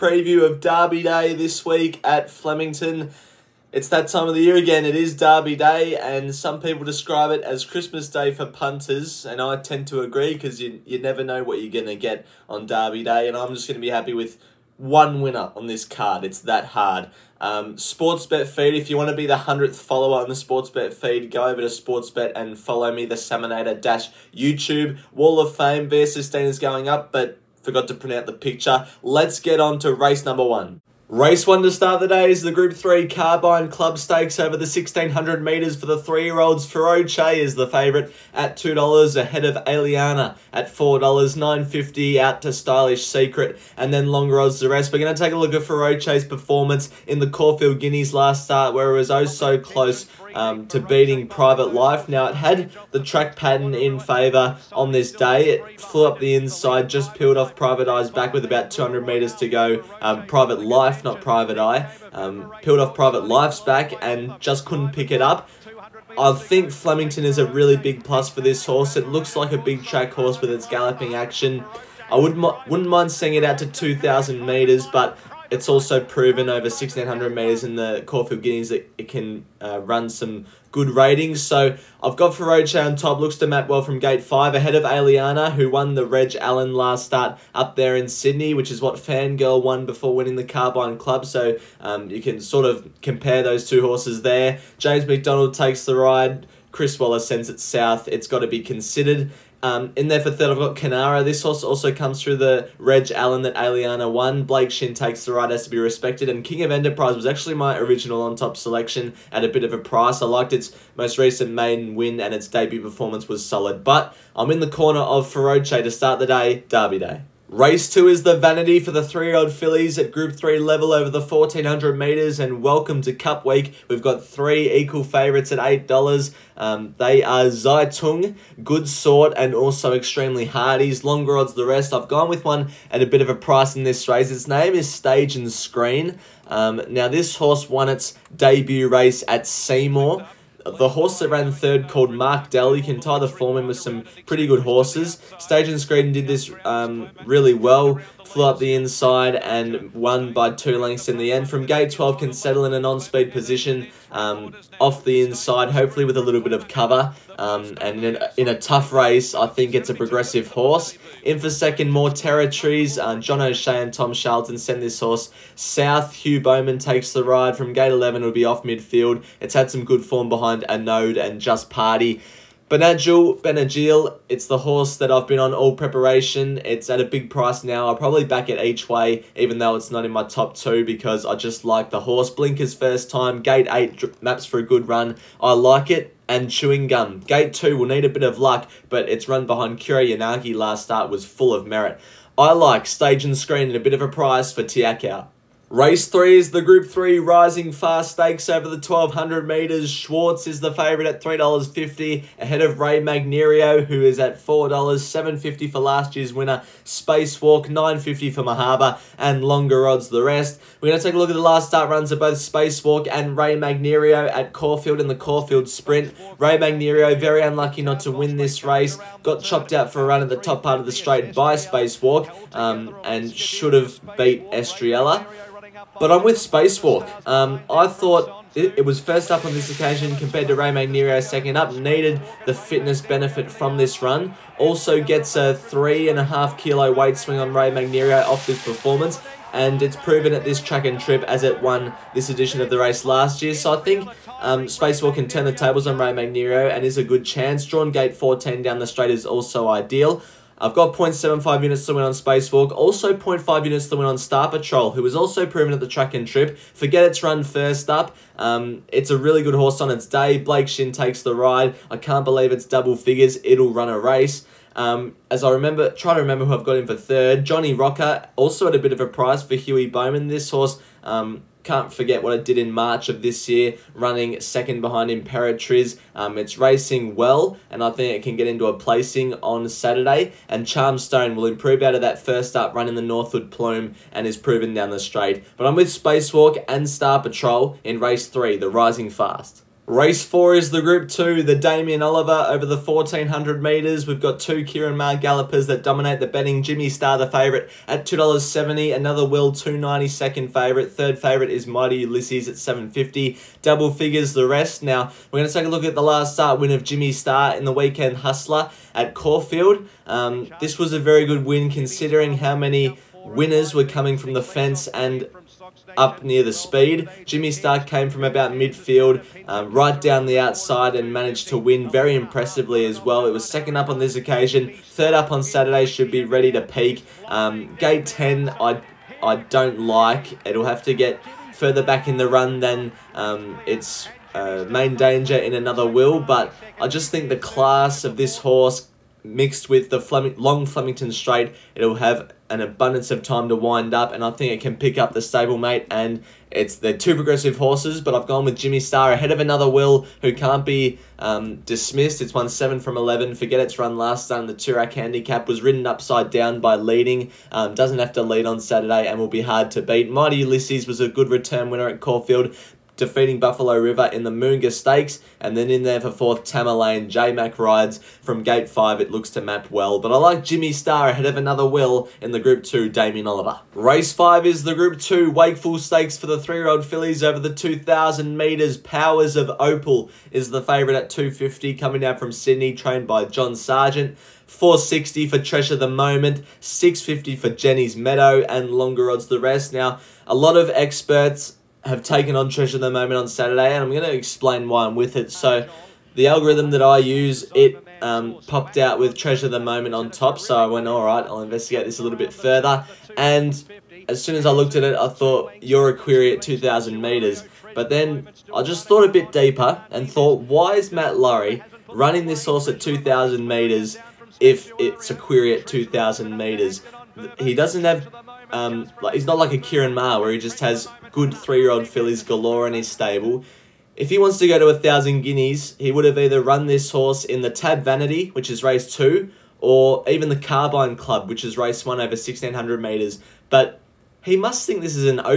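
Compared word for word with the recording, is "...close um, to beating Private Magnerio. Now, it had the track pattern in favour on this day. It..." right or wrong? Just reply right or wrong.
wrong.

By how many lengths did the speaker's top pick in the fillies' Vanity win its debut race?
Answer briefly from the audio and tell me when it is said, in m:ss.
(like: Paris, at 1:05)
2 lengths, at 2:29.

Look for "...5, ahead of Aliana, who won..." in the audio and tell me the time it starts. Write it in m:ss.
1:24.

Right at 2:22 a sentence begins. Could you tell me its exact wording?
You can tie the form in with some pretty good horses.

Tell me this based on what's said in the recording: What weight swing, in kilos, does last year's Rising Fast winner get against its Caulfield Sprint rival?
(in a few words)
3.5 kilos.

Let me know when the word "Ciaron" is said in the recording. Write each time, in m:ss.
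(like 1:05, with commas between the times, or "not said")
4:54, 6:59.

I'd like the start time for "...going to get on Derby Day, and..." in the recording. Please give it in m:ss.
0:11.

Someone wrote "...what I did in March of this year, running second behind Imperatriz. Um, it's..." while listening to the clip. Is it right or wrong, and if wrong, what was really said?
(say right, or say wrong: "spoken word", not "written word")
right.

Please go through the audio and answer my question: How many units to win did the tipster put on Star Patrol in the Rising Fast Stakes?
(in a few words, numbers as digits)
0.5 units.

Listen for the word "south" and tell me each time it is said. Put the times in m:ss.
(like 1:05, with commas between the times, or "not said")
1:37, 2:45.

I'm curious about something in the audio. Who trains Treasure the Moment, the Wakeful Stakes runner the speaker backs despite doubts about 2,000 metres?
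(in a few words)
Matt Laurie.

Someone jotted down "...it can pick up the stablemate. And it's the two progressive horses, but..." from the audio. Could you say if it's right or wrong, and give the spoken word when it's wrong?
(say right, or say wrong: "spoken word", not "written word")
right.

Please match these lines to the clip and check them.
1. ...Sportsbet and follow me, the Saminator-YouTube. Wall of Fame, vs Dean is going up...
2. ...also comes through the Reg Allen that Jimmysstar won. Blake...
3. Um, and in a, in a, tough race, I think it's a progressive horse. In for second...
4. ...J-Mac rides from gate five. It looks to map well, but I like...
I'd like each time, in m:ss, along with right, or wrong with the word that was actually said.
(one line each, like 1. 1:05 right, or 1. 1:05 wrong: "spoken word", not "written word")
1. 0:21 right
2. 1:41 wrong: "Aliana", not "Jimmysstar"
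3. 2:37 right
4. 6:07 right.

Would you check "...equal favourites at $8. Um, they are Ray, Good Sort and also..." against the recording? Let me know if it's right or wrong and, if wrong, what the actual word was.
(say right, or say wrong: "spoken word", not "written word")
wrong: "Zaitung", not "Ray".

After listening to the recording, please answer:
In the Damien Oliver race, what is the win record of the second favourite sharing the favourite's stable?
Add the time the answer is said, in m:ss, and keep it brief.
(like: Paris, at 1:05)
7 from 11, at 5:52.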